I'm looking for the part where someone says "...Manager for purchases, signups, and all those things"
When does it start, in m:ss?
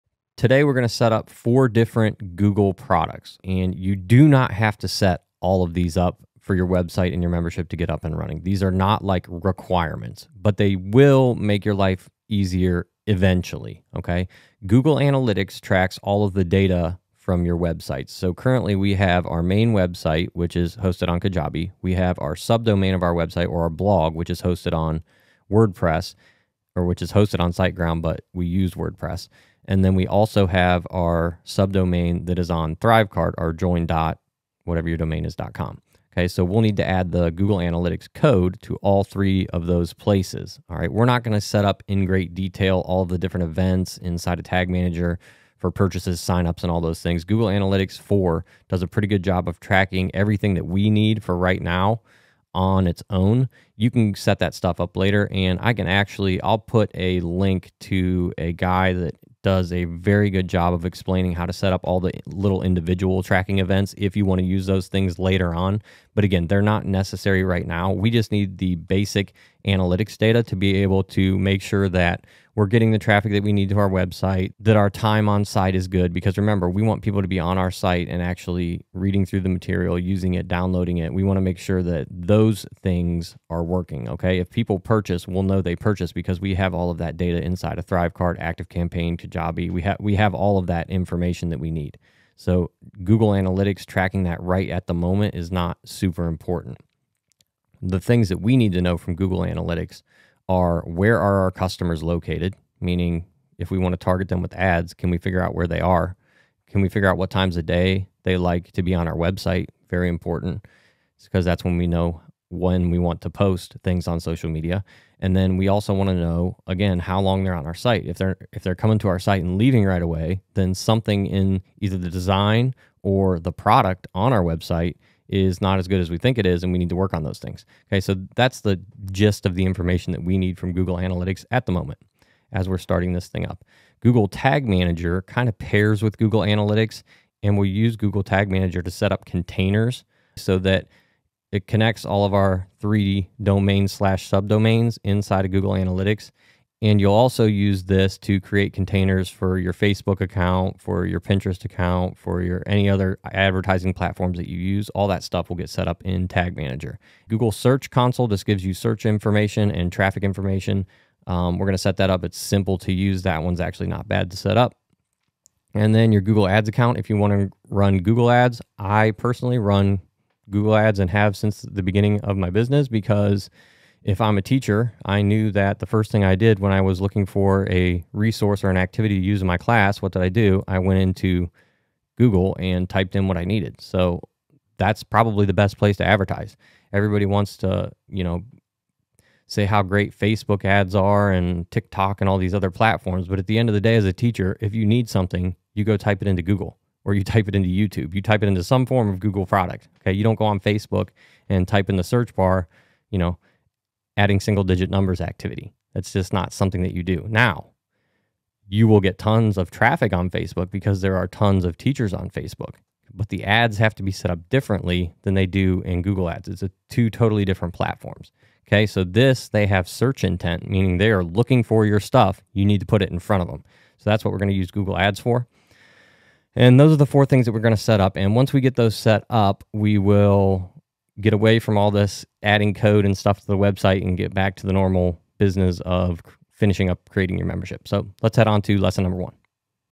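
0:44.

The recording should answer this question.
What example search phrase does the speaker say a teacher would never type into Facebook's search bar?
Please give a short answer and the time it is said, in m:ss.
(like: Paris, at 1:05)
adding single digit numbers activity, at 3:24.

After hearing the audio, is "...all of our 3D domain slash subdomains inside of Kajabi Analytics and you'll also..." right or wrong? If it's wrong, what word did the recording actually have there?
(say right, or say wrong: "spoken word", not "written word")
wrong: "Google", not "Kajabi".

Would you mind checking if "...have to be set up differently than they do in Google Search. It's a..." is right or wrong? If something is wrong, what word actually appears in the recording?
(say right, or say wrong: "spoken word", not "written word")
wrong: "Ads", not "Search".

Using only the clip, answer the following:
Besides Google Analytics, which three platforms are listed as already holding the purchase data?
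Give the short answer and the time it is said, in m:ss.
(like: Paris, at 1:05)
ThriveCart, ActiveCampaign, Kajabi, at 1:27.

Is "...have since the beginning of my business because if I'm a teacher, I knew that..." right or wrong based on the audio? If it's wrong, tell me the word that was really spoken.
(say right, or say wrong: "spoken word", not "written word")
right.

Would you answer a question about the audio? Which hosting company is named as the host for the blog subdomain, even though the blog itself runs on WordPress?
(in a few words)
SiteGround.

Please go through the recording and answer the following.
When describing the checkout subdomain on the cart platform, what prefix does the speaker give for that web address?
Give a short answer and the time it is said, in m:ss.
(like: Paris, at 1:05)
join, at 0:33.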